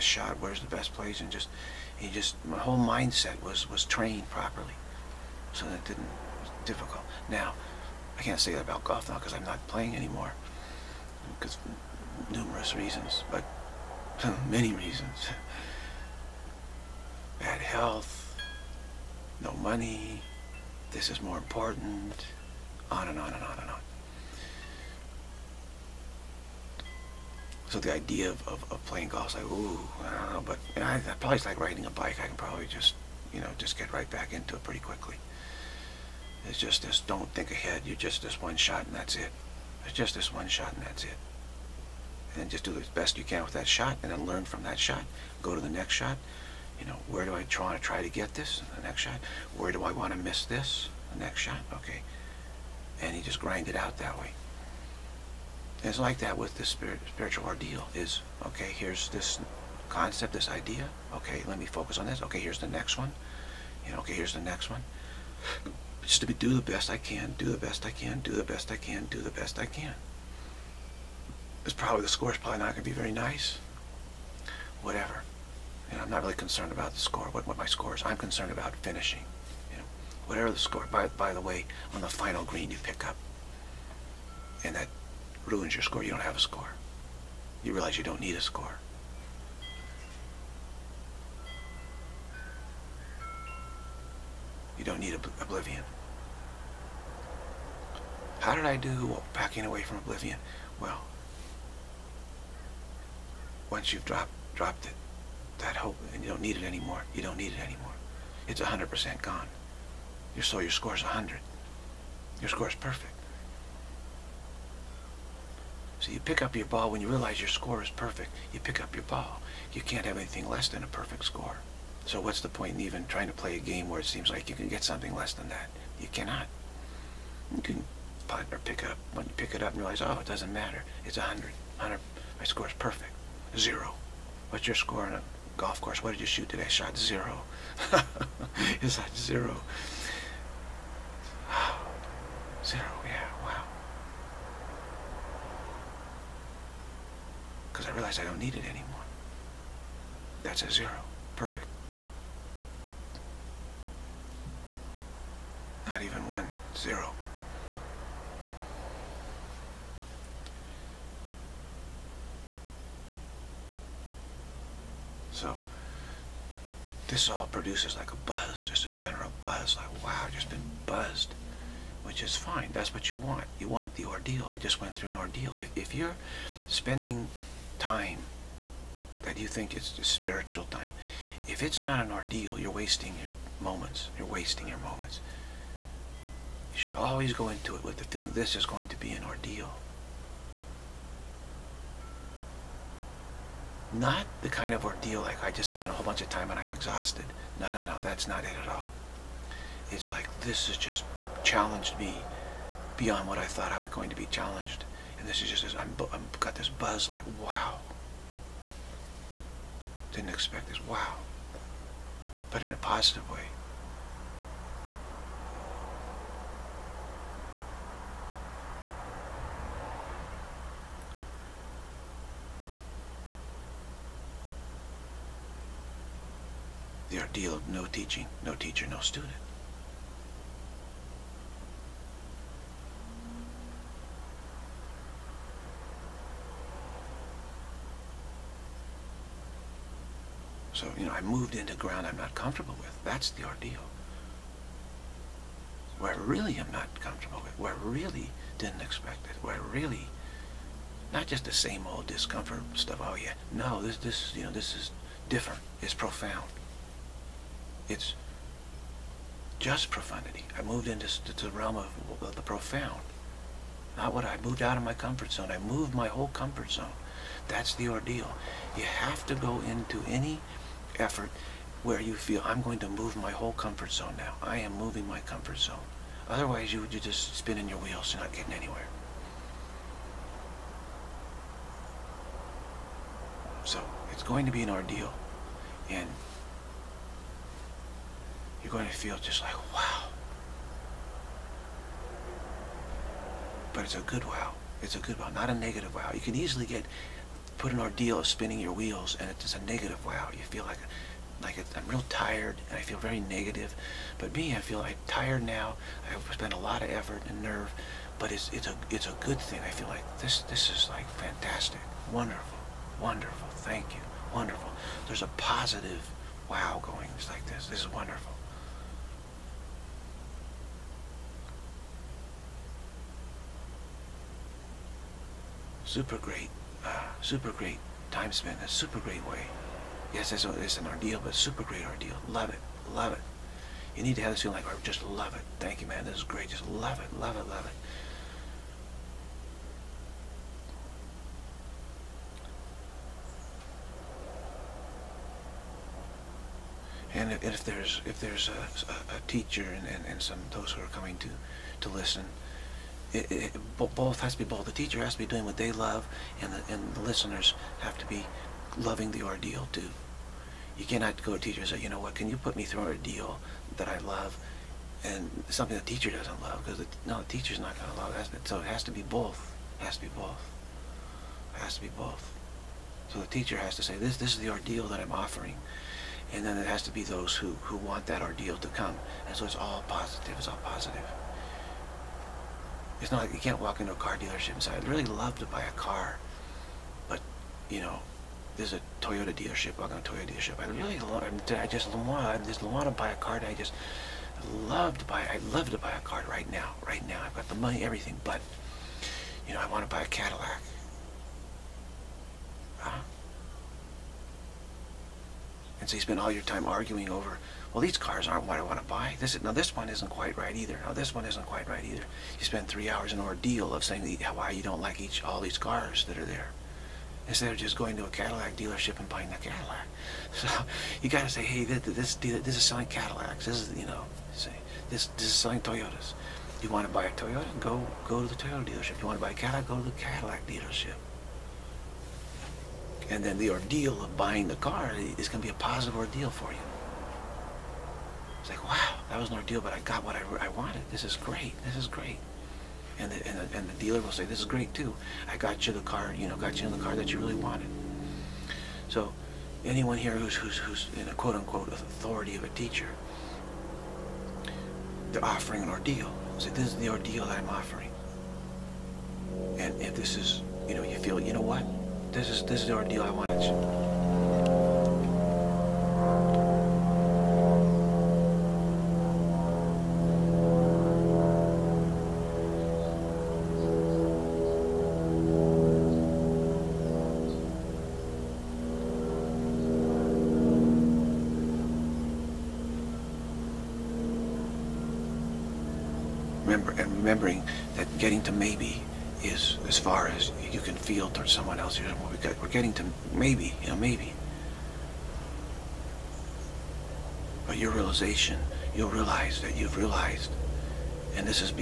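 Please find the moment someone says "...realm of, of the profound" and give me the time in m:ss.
4:21.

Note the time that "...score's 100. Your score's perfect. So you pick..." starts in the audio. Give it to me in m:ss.
1:50.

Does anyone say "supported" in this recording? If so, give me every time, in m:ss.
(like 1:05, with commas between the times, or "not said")
not said.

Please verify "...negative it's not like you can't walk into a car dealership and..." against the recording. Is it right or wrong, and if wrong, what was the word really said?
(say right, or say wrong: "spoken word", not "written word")
wrong: "positive", not "negative".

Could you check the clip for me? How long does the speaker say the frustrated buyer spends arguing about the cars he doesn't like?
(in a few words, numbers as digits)
3 hours.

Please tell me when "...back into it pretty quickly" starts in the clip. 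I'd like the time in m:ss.
0:34.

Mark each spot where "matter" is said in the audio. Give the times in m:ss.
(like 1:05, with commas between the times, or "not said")
2:10.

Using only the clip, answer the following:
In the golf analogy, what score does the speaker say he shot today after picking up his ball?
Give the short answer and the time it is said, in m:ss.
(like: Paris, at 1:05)
0, at 2:16.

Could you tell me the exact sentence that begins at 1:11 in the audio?
It's probably, the score's probably not going to be very nice.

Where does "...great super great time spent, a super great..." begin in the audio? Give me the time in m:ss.
5:26.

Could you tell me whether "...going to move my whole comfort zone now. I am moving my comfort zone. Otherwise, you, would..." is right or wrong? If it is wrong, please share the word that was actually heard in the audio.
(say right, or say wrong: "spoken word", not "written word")
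right.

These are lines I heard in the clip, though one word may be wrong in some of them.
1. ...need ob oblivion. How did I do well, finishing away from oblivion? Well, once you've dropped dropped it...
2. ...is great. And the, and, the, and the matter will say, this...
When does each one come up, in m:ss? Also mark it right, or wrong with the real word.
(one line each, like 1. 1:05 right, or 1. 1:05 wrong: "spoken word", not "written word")
1. 1:35 wrong: "backing", not "finishing"
2. 7:21 wrong: "dealer", not "matter".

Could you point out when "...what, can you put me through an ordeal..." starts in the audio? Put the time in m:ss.
6:02.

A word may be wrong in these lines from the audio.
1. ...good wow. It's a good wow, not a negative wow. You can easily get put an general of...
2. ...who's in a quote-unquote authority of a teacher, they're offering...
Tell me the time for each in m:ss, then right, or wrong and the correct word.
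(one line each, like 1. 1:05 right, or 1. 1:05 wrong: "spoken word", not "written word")
1. 4:54 wrong: "ordeal", not "general"
2. 7:30 right.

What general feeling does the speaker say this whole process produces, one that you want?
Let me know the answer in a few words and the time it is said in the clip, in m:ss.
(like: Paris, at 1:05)
a buzz, at 2:48.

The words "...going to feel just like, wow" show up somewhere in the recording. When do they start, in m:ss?
4:48.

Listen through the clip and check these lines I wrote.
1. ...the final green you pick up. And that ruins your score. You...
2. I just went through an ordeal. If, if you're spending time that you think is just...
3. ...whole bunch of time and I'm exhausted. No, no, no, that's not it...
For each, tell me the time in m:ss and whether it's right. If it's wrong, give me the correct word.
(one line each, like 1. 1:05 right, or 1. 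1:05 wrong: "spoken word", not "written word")
1. 1:22 right
2. 2:54 right
3. 3:15 right.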